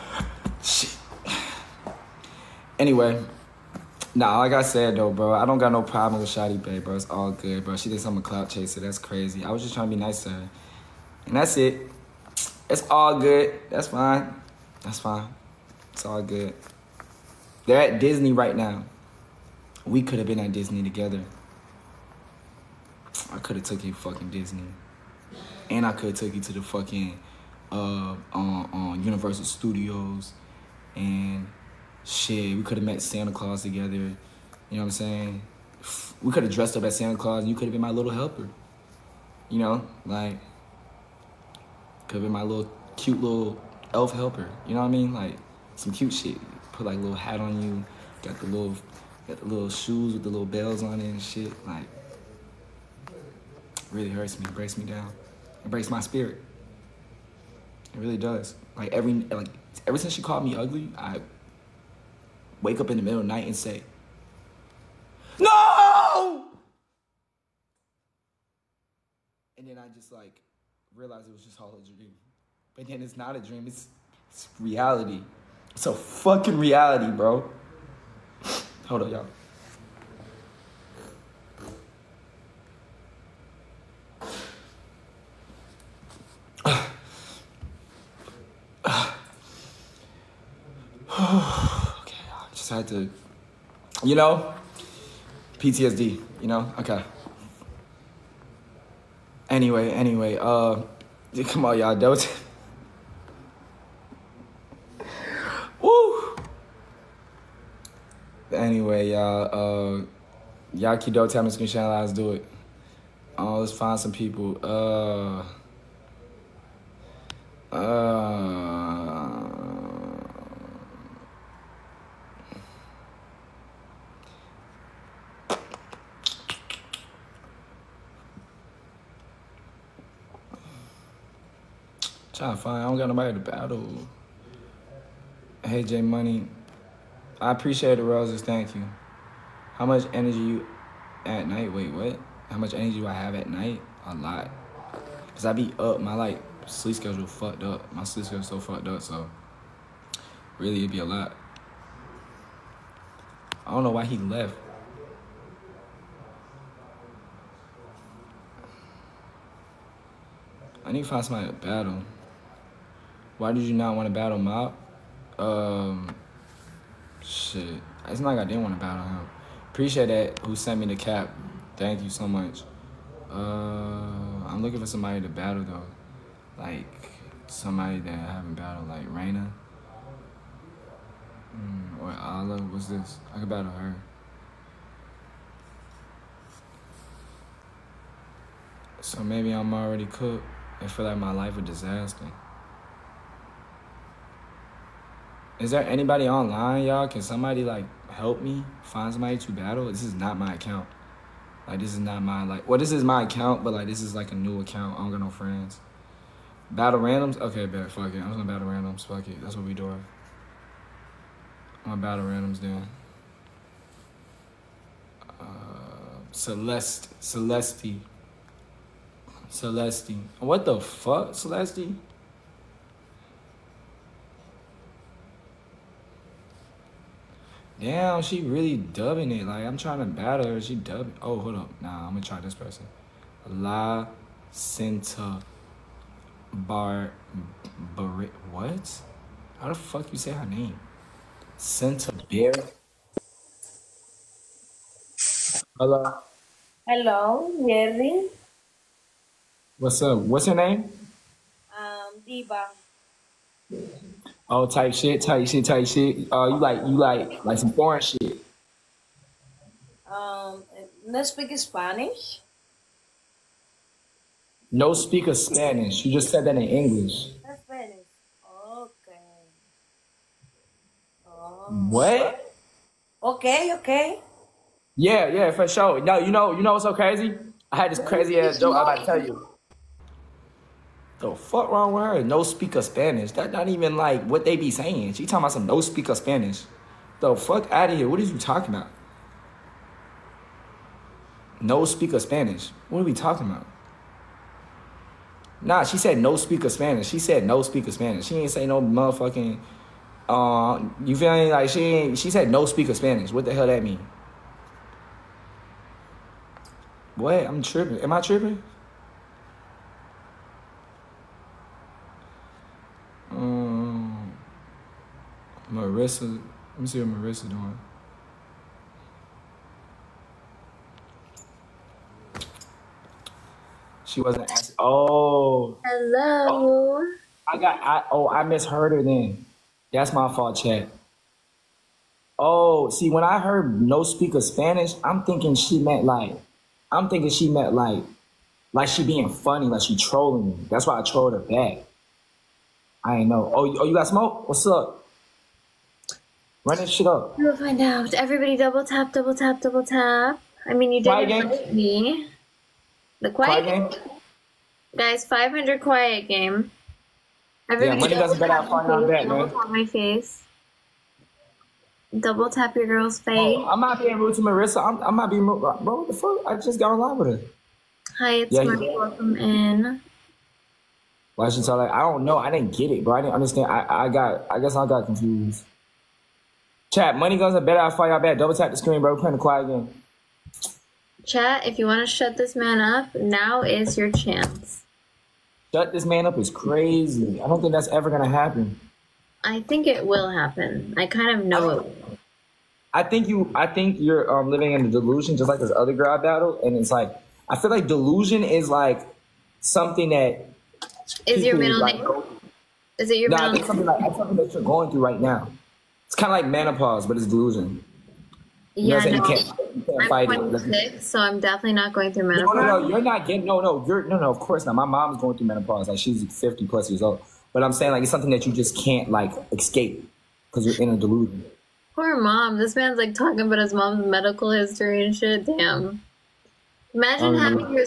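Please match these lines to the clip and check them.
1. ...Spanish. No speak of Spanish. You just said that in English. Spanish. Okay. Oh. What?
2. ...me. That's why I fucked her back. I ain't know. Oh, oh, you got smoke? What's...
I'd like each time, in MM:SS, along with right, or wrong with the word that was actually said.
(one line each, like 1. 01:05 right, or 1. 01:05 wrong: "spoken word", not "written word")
1. 04:21 right
2. 05:40 wrong: "trolled", not "fucked".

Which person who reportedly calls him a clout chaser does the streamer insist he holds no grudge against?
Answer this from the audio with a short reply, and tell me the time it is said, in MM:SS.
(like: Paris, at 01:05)
Shotty Bay, at 00:06.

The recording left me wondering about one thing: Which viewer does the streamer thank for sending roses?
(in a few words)
J Money.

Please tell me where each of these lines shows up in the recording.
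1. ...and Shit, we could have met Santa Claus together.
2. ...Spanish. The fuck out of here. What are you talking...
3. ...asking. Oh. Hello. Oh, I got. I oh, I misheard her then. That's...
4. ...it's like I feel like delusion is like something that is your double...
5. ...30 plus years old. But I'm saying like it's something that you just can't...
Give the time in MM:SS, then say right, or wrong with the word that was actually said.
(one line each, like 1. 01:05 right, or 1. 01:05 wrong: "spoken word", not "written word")
1. 00:30 right
2. 04:46 right
3. 05:24 right
4. 06:36 wrong: "middle", not "double"
5. 06:56 wrong: "50", not "30".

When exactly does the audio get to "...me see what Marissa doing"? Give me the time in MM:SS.
05:16.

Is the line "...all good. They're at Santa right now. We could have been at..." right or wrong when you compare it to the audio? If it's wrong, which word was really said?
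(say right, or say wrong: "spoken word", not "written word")
wrong: "Disney", not "Santa".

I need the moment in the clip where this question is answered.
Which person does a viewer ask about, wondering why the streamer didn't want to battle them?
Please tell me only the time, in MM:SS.
02:44.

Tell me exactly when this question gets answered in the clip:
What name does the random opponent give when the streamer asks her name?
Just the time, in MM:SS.
04:12.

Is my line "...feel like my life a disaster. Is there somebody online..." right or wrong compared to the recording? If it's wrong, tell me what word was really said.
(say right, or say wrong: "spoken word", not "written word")
wrong: "anybody", not "somebody".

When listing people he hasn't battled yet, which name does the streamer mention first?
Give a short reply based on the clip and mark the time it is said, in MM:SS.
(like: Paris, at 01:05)
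Raina, at 02:59.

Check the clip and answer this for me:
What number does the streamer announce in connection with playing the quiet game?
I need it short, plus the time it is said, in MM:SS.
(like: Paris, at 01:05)
500, at 05:55.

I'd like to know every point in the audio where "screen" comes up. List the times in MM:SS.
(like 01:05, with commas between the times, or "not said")
01:51, 06:18.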